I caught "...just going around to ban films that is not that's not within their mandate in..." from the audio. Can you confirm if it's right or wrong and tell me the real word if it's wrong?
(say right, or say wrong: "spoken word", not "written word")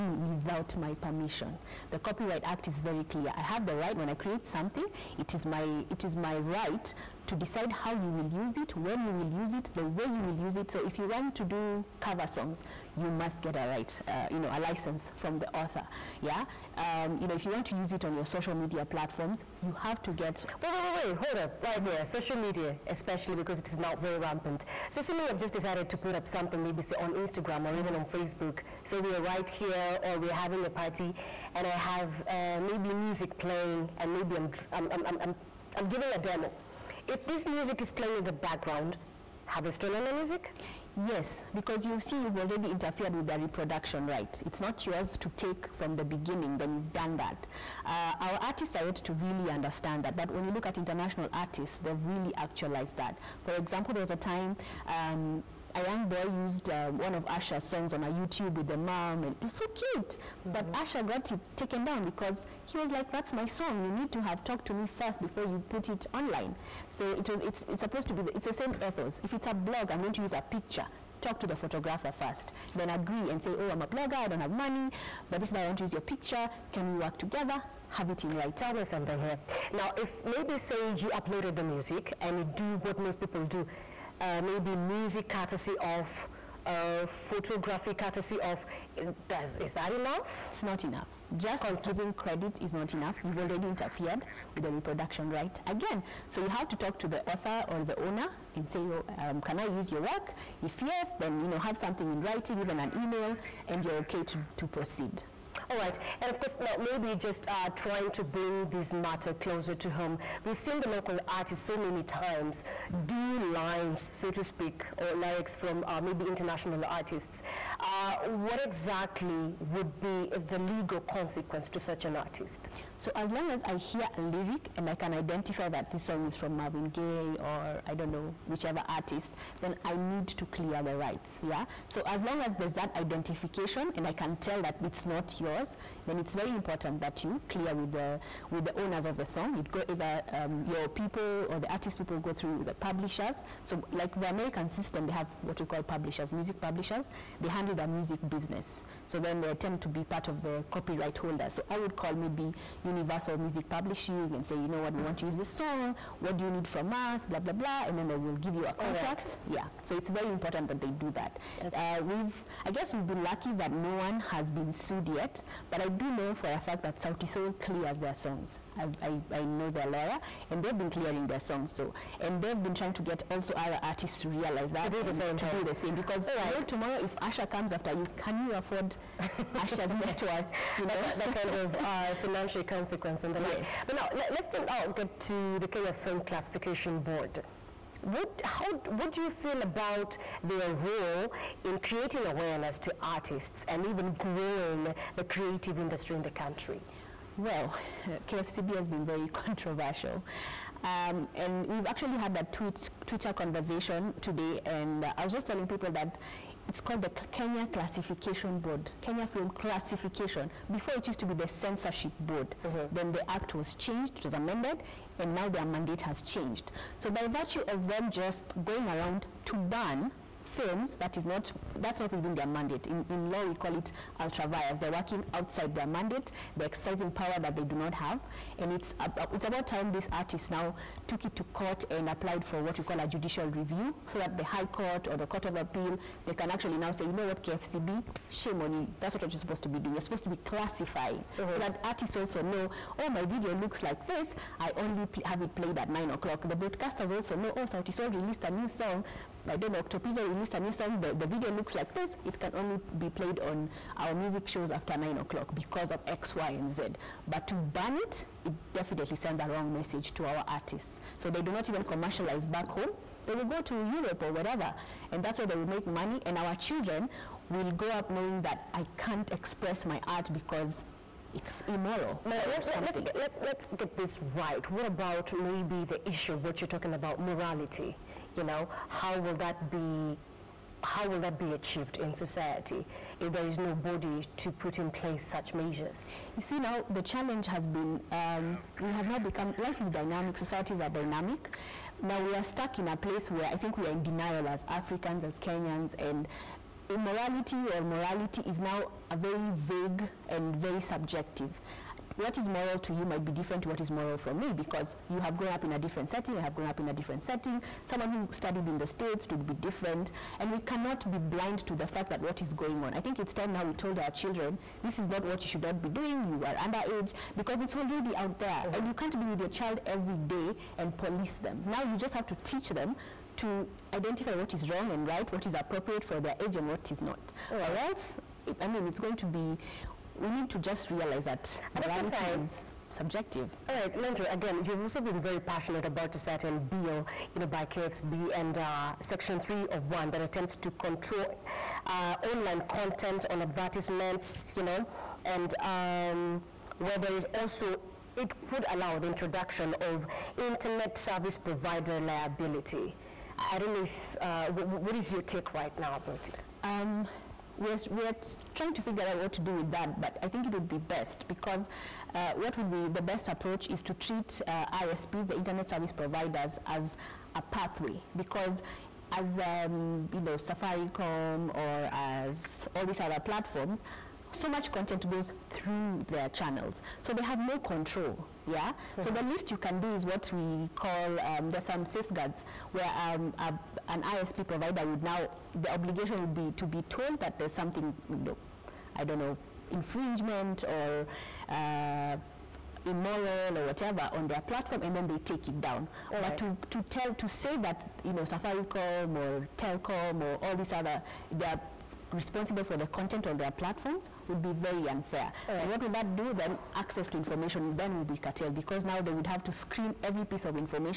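right.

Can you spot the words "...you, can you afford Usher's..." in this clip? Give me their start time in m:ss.
2:57.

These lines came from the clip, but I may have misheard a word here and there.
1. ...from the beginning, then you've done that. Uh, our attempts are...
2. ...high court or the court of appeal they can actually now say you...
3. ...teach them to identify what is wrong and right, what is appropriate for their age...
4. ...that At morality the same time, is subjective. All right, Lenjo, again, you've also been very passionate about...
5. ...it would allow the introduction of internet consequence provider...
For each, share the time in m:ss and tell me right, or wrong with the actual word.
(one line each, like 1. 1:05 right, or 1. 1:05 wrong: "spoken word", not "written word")
1. 0:45 wrong: "artists", not "attempts"
2. 3:54 right
3. 5:22 right
4. 5:31 right
5. 5:48 wrong: "service", not "consequence".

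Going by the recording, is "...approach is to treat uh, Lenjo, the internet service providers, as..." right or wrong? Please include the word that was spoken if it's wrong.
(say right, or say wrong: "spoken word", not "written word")
wrong: "ISPs", not "Lenjo".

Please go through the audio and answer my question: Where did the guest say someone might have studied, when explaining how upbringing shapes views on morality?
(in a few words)
The States.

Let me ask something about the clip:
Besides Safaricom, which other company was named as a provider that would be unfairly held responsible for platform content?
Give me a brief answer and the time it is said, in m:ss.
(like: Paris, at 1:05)
Telkom, at 6:39.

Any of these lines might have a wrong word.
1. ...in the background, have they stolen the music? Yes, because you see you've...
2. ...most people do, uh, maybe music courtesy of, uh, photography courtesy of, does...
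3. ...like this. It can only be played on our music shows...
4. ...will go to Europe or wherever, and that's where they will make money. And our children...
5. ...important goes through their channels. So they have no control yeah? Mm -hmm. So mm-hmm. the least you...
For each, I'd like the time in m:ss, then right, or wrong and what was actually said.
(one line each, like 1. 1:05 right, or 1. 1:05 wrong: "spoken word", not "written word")
1. 0:38 right
2. 1:22 right
3. 4:11 right
4. 4:23 right
5. 6:14 wrong: "content", not "important".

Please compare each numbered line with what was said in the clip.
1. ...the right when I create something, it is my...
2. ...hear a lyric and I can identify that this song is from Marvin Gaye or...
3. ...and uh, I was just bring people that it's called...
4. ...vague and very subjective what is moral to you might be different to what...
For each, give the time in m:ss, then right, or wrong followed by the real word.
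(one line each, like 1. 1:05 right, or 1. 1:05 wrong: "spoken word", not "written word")
1. 0:03 right
2. 2:03 right
3. 3:24 wrong: "telling", not "bring"
4. 4:59 right.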